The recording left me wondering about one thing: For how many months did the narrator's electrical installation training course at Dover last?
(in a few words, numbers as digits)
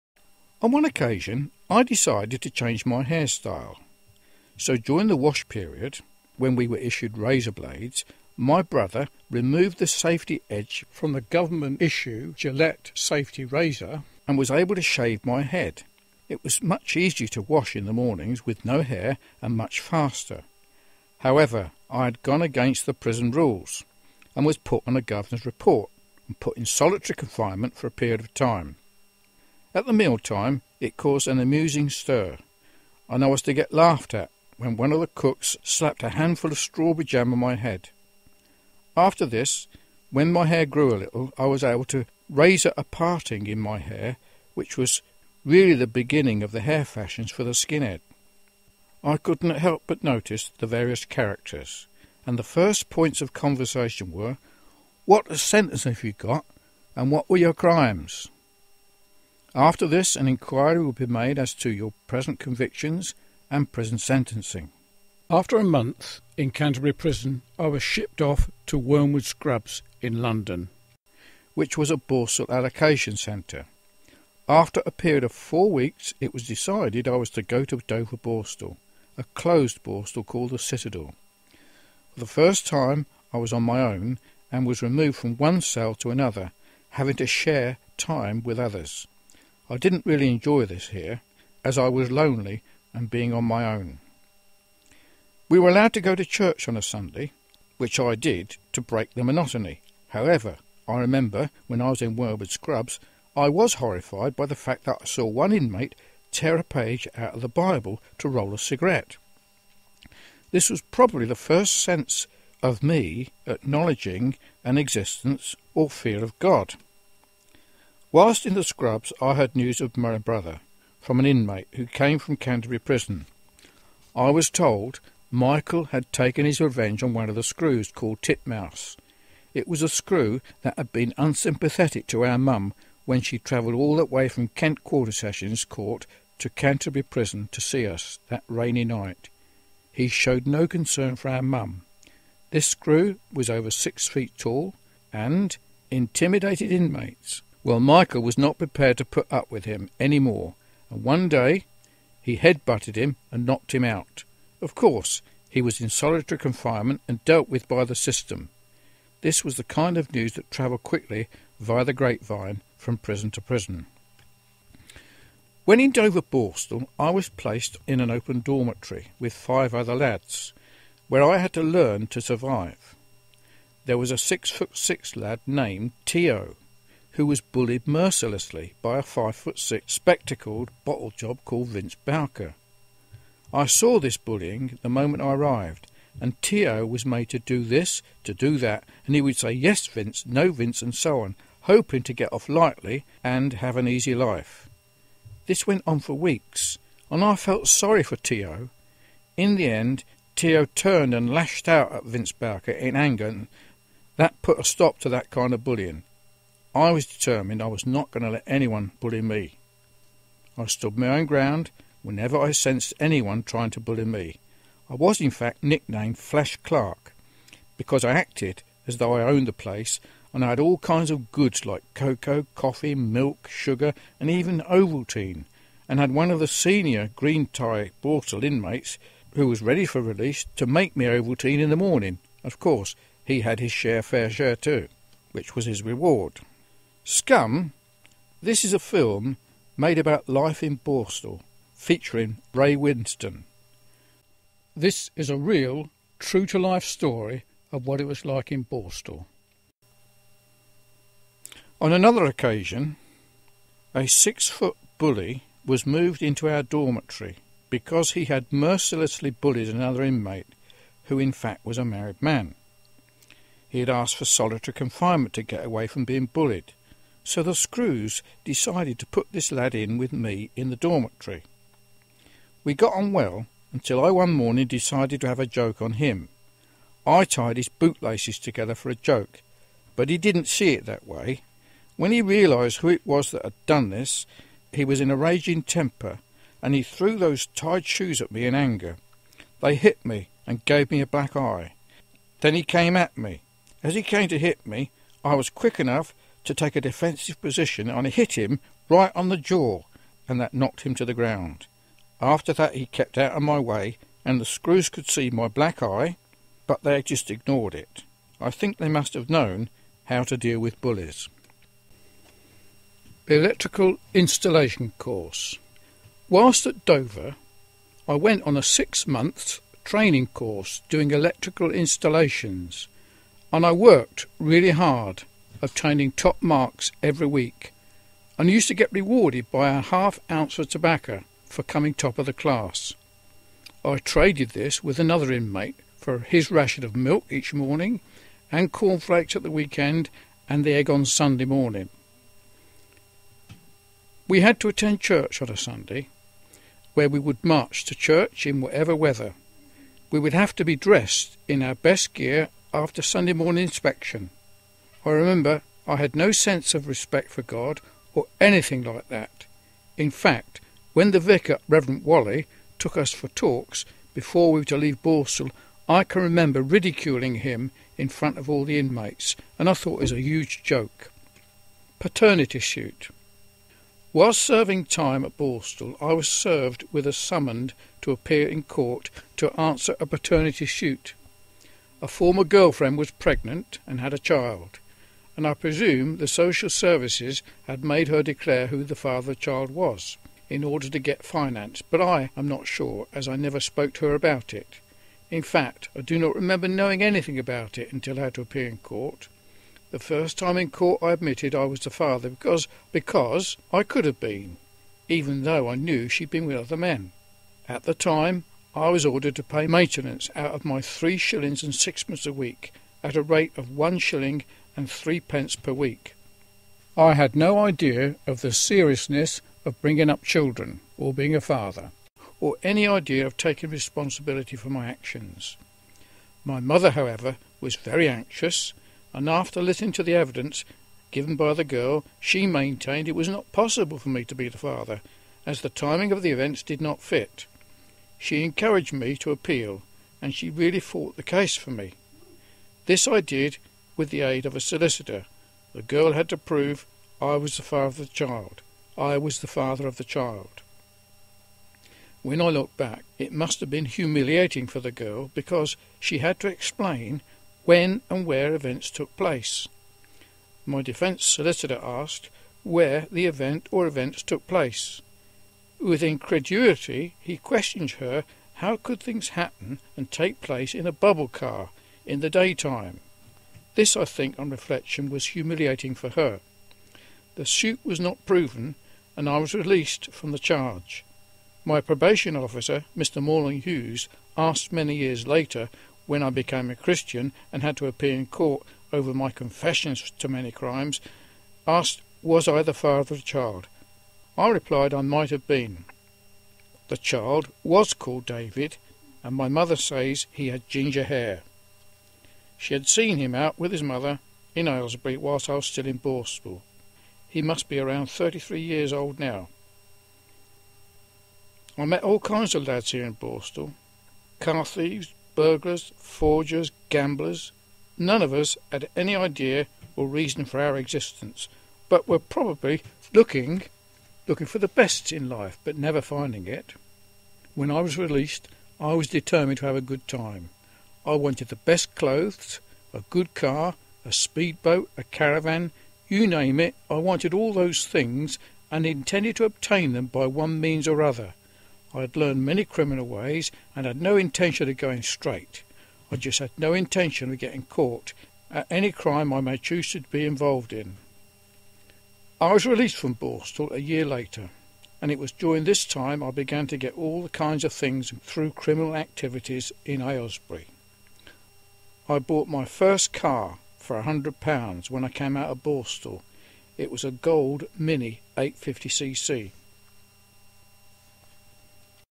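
6.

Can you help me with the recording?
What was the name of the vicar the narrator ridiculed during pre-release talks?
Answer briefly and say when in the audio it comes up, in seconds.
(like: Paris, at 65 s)
Reverend Wally, at 361 s.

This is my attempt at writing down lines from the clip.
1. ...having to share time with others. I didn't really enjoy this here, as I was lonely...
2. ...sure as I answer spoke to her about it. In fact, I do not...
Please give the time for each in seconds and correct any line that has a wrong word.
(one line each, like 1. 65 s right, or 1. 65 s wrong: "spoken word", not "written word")
1. 86 s right
2. 392 s wrong: "never", not "answer".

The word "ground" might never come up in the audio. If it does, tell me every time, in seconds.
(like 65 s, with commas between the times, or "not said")
211 s, 301 s.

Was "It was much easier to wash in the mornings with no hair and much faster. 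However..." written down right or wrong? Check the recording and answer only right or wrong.
right.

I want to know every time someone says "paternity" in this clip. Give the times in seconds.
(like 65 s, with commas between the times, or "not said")
371 s, 380 s.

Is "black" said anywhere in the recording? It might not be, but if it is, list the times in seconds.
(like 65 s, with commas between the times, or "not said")
291 s, 305 s.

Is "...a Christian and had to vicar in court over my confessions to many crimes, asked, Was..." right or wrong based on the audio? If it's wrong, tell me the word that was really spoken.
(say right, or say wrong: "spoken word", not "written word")
wrong: "appear", not "vicar".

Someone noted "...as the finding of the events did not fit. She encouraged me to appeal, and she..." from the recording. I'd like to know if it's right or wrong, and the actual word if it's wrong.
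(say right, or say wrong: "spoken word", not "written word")
wrong: "timing", not "finding".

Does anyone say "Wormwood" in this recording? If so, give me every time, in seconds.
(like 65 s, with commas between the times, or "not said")
68 s, 102 s.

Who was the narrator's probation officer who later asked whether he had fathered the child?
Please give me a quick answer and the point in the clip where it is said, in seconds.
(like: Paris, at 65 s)
Mr. Morland Hughes, at 482 s.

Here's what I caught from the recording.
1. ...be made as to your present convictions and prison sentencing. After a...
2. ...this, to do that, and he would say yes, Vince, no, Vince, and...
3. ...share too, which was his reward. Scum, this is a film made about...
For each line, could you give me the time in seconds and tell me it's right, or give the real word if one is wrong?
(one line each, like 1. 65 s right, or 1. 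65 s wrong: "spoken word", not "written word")
1. 60 s right
2. 187 s right
3. 234 s right.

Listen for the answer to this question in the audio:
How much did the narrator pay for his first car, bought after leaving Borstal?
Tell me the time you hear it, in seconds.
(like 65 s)
564 s.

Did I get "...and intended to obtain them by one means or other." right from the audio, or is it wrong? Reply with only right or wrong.
right.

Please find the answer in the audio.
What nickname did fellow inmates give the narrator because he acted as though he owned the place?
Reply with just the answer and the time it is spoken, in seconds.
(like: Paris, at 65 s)
Flash Clarke, at 216 s.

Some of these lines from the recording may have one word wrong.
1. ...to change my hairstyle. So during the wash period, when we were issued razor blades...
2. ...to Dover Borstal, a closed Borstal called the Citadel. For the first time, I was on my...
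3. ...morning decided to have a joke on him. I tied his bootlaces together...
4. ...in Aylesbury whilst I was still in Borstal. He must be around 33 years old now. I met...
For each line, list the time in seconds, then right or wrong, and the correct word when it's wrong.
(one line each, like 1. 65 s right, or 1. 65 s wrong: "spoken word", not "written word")
1. 2 s right
2. 77 s right
3. 274 s right
4. 504 s right.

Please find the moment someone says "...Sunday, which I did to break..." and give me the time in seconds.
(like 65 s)
96 s.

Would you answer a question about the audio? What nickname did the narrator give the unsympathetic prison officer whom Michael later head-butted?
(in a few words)
Titmouse.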